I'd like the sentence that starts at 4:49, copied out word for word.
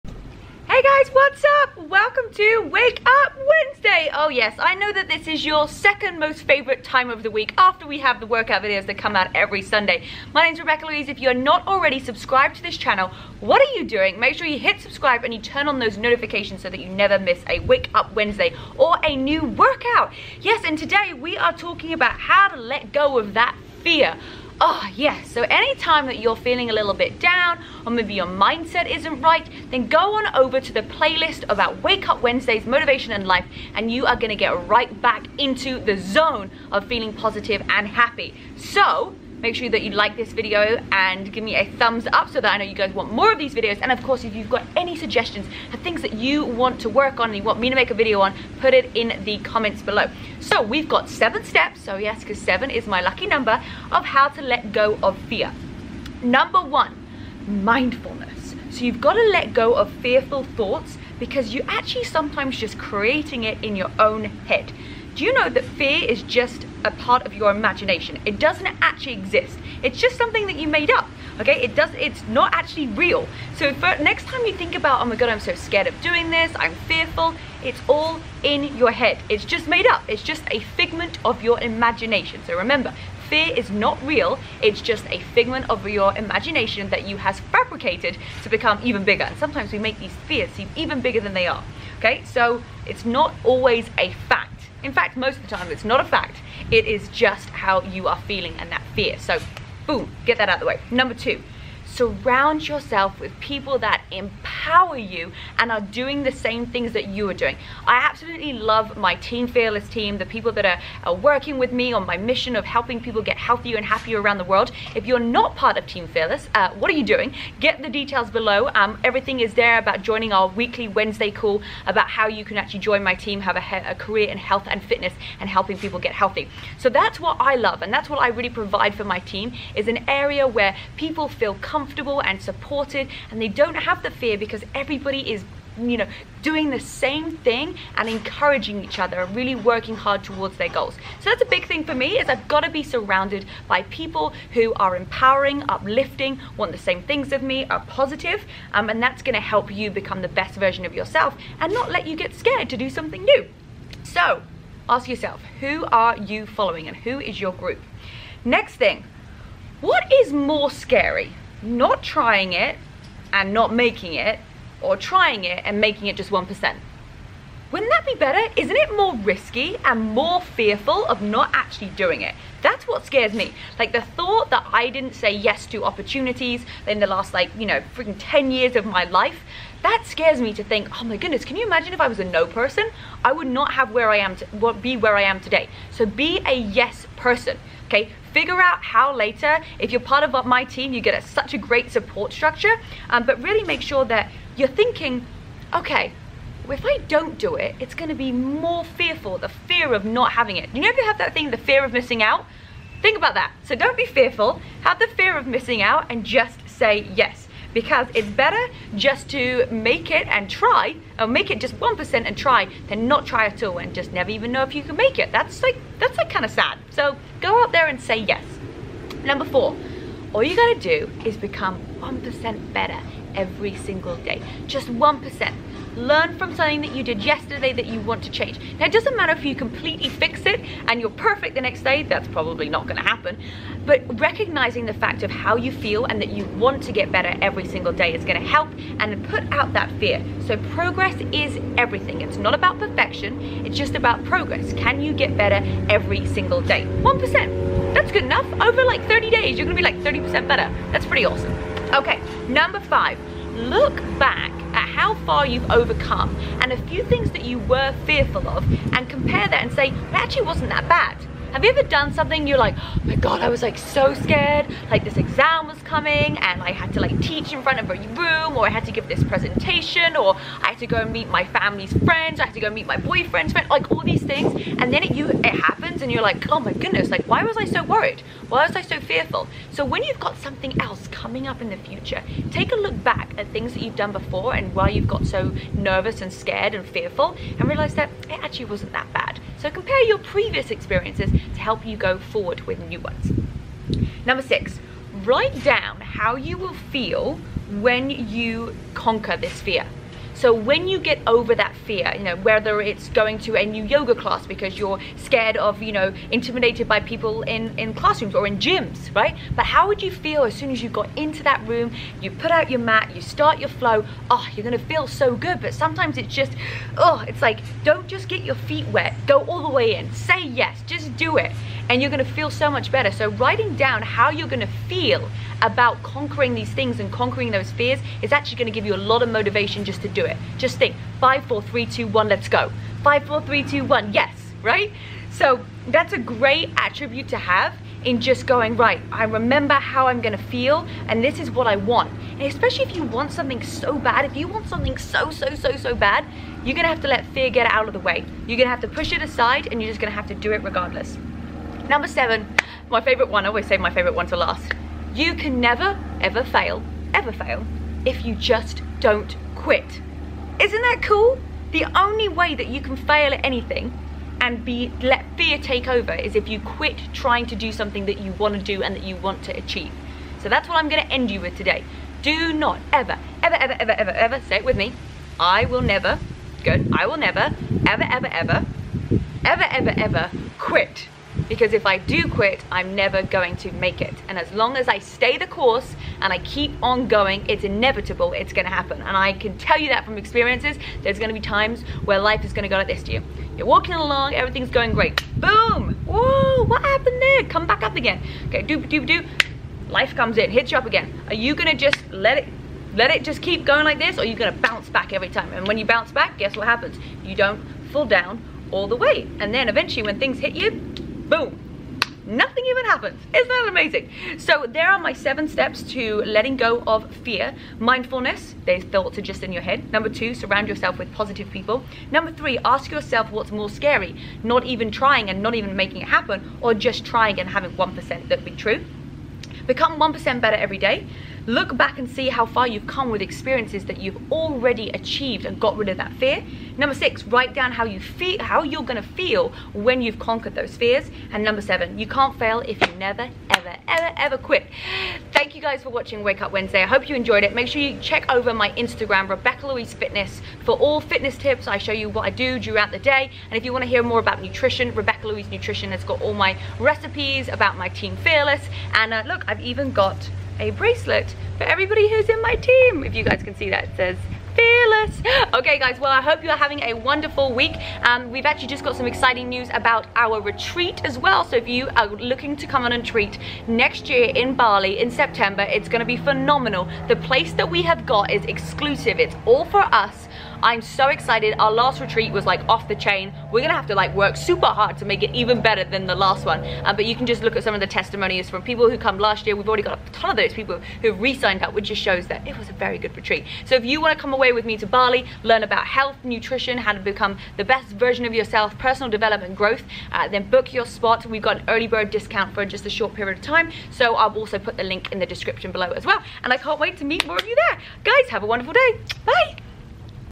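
So compare your previous experiences to help you go forward with new ones.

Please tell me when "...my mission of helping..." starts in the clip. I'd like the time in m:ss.
1:52.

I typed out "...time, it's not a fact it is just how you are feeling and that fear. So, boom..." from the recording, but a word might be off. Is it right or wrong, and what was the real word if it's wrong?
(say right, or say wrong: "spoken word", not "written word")
right.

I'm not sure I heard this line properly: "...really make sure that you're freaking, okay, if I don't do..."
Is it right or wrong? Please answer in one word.
wrong.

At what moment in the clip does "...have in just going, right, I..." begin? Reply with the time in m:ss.
5:37.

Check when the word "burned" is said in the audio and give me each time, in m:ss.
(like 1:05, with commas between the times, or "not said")
not said.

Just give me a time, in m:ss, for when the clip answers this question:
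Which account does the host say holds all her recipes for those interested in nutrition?
7:34.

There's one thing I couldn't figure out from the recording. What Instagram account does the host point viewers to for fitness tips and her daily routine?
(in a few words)
Rebecca Louise Fitness.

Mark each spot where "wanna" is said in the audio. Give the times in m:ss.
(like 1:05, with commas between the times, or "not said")
7:33, 8:13.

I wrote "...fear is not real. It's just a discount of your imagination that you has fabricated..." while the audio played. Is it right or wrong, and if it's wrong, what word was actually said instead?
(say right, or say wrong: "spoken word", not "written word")
wrong: "figment", not "discount".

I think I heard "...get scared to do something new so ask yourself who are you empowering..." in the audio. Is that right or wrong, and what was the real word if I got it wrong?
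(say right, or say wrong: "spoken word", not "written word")
wrong: "following", not "empowering".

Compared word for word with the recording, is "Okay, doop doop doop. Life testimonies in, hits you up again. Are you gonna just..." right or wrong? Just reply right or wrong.
wrong.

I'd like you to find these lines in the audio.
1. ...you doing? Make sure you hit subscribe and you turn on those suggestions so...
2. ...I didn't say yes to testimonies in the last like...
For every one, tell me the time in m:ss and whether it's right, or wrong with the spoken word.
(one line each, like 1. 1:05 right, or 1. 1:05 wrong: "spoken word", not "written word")
1. 0:13 wrong: "notifications", not "suggestions"
2. 2:54 wrong: "opportunities", not "testimonies".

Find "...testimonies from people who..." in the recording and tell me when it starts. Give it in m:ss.
8:07.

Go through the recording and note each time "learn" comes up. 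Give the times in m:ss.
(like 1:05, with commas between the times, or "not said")
3:45, 8:15.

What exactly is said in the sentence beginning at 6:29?
And I can tell you that from experiences, there's gonna be times where life is gonna go like this to you.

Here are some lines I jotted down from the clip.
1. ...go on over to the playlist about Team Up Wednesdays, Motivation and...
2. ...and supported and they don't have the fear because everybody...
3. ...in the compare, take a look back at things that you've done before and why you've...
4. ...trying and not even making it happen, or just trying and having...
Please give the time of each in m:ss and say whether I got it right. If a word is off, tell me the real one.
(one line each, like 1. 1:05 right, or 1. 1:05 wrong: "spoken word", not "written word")
1. 0:29 wrong: "Wake", not "Team"
2. 2:12 right
3. 4:41 wrong: "future", not "compare"
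4. 7:04 right.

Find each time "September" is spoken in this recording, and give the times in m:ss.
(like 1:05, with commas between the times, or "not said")
7:55.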